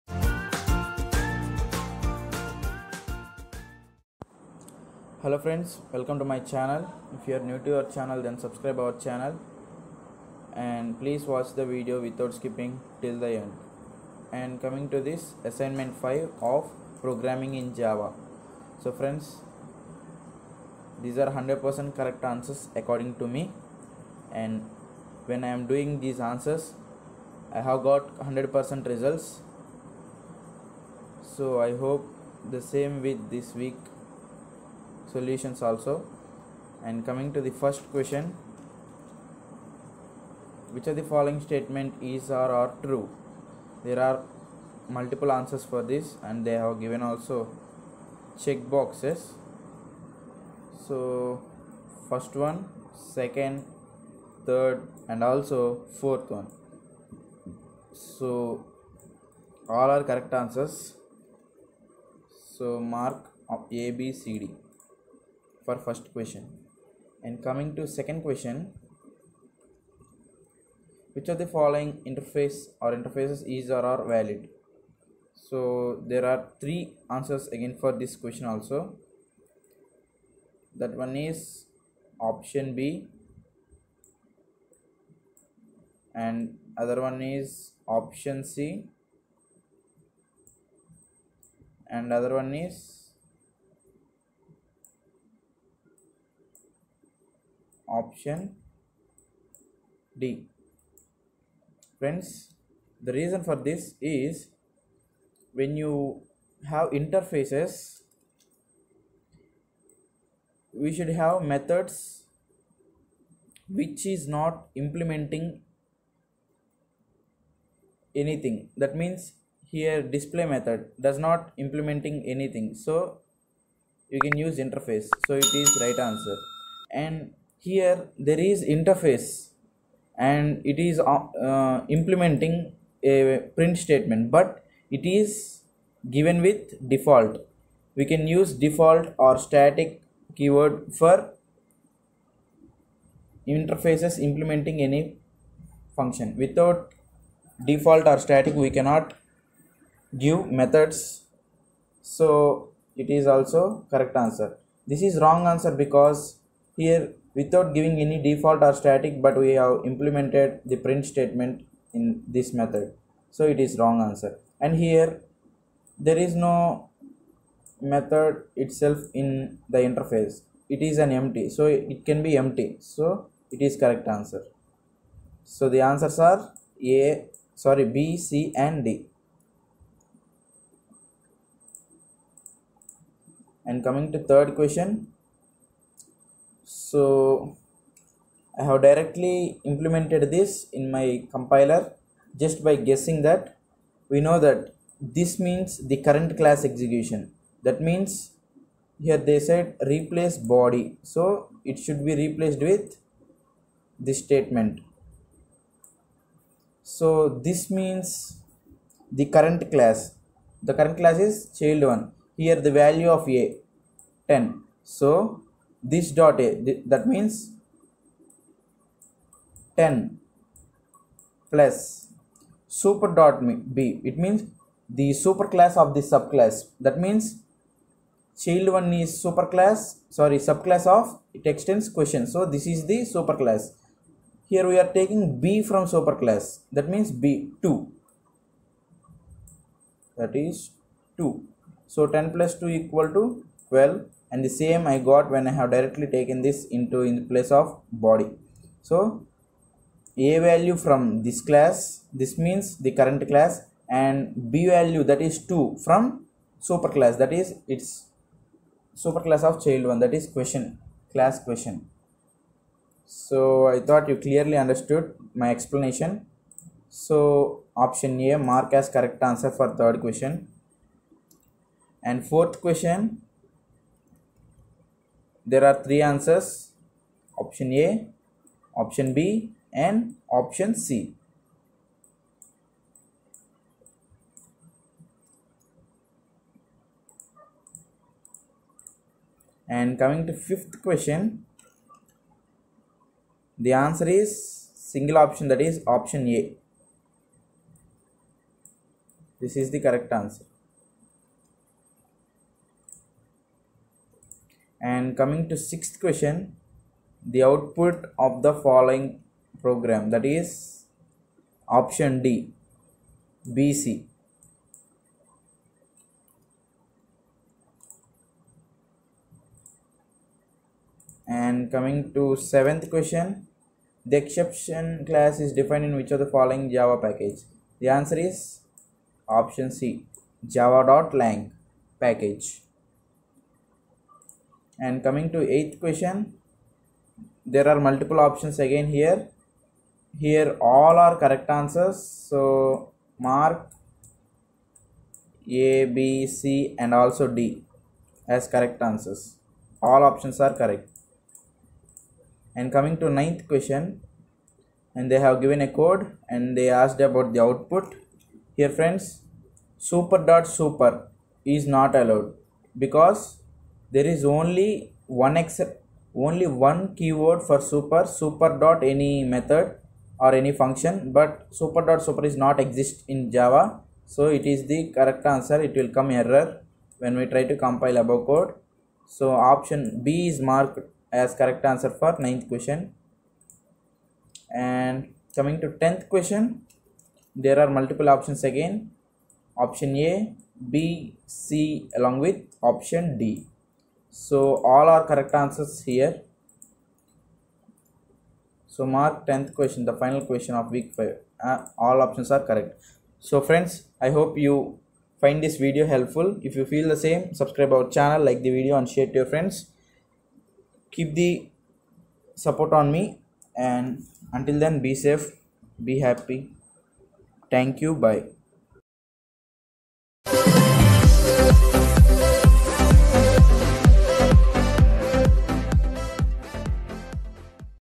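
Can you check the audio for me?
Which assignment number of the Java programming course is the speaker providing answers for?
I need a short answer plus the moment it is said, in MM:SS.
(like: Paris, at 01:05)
5, at 00:15.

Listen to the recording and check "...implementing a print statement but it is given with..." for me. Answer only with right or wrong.
right.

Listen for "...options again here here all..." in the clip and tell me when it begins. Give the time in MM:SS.
05:38.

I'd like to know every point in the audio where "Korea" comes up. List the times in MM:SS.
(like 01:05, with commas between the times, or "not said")
not said.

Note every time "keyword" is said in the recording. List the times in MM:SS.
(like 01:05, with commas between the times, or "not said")
02:20, 06:06.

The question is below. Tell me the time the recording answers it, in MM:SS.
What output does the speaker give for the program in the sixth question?
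05:13.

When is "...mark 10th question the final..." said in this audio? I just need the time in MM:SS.
06:38.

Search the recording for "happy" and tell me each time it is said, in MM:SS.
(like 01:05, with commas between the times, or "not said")
06:56.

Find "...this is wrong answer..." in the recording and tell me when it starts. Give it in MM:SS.
02:34.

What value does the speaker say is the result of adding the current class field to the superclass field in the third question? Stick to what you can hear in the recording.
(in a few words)
12.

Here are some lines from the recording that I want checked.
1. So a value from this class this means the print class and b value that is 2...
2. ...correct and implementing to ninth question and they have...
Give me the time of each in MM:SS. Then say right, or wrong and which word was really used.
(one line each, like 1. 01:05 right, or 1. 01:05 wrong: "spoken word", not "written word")
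1. 04:08 wrong: "current", not "print"
2. 05:50 wrong: "coming", not "implementing".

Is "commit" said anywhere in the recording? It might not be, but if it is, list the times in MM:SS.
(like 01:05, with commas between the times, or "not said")
not said.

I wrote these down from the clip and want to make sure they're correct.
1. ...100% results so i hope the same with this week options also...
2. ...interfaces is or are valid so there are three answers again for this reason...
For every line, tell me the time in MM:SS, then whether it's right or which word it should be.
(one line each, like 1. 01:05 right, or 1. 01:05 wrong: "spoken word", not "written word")
1. 00:28 wrong: "solutions", not "options"
2. 01:12 wrong: "question", not "reason".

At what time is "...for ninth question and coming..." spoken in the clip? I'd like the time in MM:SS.
06:22.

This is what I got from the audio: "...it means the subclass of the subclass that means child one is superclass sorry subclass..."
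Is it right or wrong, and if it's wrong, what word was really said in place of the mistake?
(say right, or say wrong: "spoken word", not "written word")
wrong: "superclass", not "subclass".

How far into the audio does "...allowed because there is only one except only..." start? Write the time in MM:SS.
06:02.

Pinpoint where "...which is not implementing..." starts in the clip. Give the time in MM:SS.
01:53.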